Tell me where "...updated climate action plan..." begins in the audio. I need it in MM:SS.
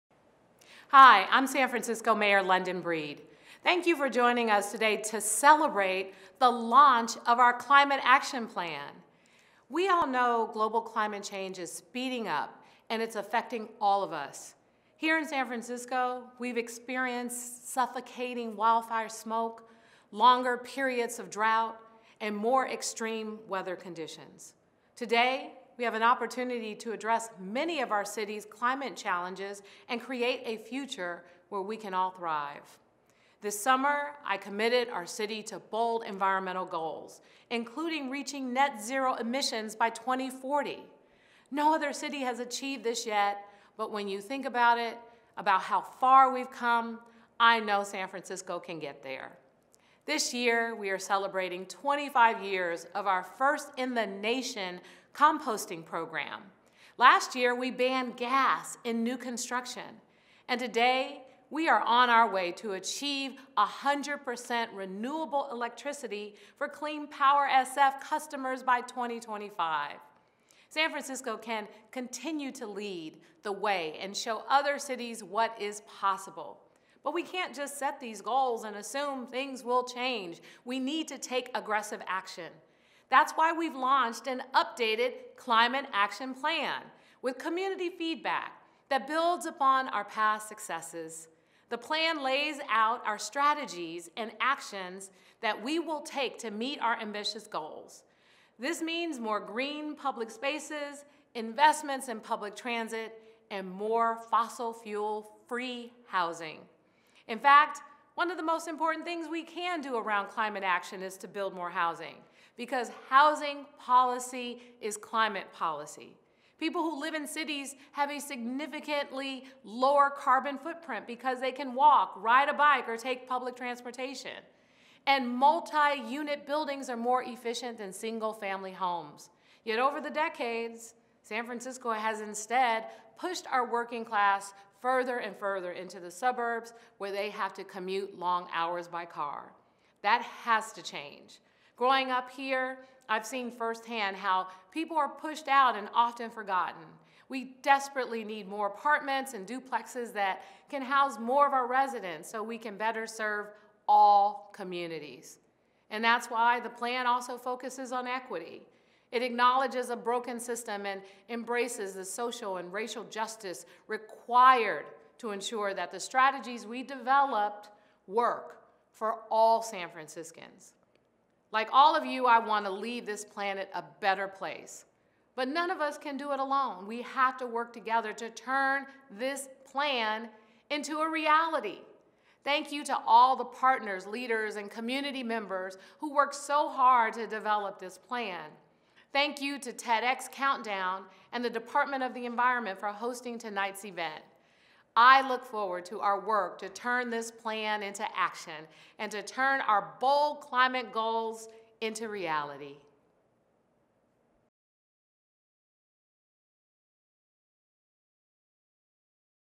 01:24.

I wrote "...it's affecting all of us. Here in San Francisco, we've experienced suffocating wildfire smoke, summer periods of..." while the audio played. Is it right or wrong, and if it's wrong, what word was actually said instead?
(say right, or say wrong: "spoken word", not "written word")
wrong: "longer", not "summer".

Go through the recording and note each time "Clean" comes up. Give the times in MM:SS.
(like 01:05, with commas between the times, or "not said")
01:06.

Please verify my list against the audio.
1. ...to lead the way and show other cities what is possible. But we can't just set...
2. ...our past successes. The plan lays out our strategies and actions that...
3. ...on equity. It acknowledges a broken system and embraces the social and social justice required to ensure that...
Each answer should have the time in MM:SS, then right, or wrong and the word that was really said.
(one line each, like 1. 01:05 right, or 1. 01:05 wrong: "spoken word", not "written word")
1. 01:12 right
2. 01:29 right
3. 02:37 wrong: "racial", not "social".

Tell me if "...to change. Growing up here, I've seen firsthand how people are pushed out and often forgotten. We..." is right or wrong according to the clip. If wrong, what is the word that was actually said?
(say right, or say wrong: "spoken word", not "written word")
right.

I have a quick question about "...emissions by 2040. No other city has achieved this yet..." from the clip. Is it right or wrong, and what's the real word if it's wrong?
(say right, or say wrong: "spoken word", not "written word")
right.